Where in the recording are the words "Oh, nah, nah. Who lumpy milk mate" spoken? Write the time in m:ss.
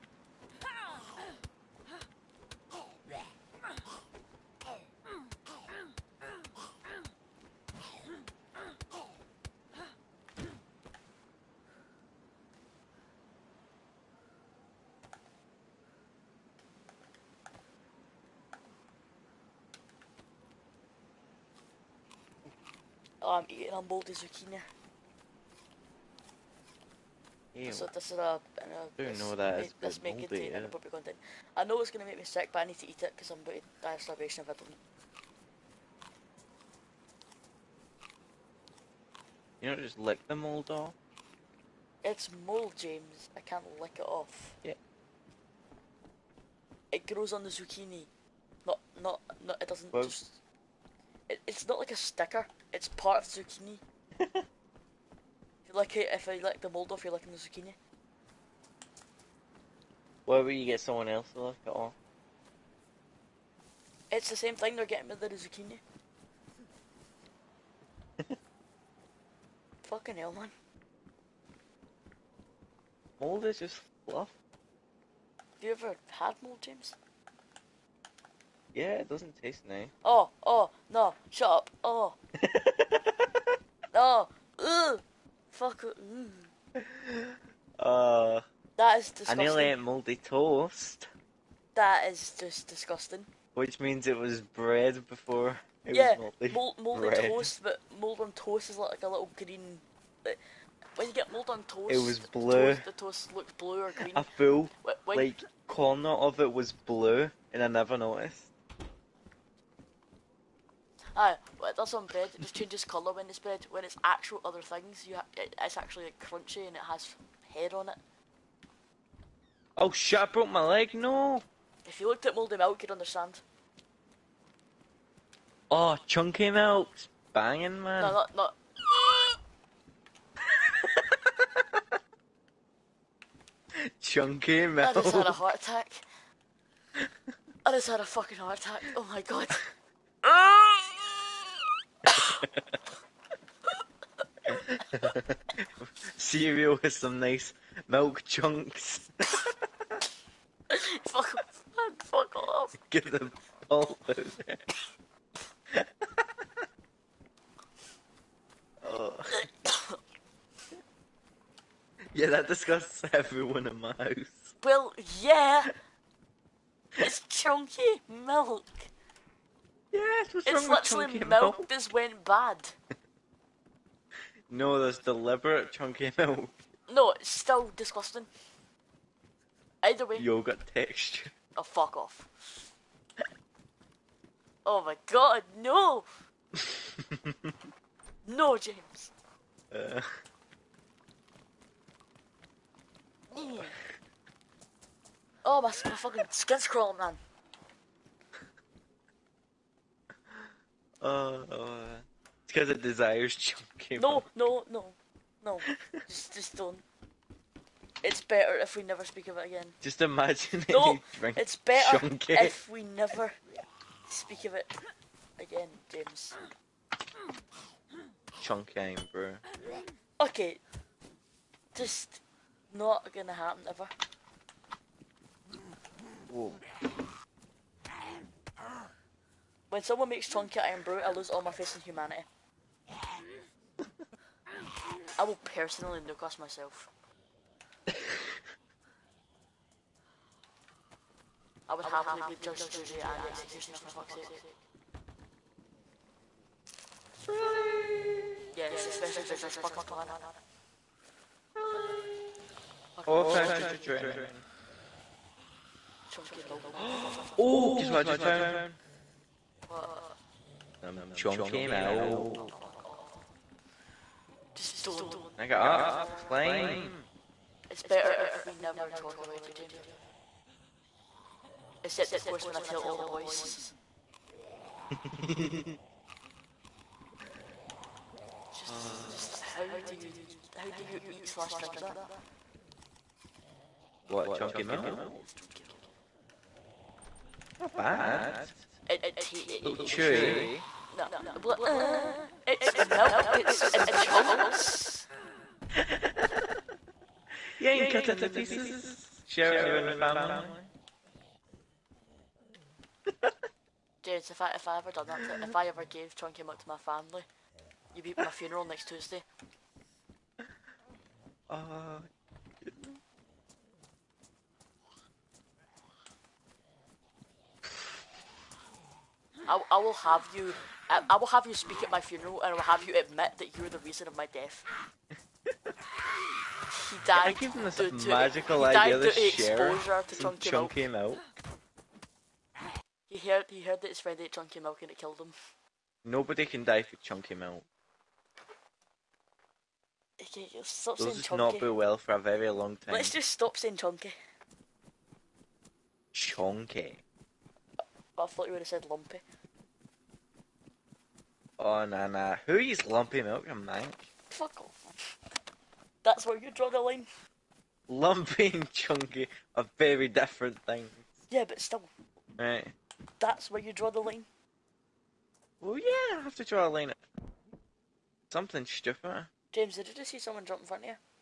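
5:51.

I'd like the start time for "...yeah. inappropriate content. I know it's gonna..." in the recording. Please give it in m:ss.
0:30.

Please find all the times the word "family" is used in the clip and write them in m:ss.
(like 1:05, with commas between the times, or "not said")
4:59, 5:06.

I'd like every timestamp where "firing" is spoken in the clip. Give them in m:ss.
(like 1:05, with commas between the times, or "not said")
not said.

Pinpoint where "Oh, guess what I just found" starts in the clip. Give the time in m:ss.
4:17.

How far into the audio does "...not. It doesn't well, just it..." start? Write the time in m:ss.
0:49.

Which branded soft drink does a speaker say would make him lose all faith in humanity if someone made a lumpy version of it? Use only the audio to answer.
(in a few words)
Irn-Bru.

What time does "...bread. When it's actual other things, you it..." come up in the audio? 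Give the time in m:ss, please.
1:53.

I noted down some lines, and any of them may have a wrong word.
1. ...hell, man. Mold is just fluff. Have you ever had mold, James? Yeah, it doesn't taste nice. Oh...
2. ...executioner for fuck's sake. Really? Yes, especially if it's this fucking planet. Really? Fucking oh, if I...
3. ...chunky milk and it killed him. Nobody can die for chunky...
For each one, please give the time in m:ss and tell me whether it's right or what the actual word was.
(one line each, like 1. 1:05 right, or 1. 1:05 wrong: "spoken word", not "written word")
1. 1:10 right
2. 4:03 right
3. 5:34 right.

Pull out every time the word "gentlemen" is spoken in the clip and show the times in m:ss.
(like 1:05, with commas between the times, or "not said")
not said.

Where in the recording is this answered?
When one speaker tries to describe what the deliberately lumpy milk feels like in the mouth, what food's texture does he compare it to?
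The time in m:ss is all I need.
3:00.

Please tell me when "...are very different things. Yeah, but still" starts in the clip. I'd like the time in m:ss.
5:59.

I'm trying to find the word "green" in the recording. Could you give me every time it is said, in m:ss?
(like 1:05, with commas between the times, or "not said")
1:39, 1:43.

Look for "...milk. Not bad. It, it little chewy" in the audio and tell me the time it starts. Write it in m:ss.
4:45.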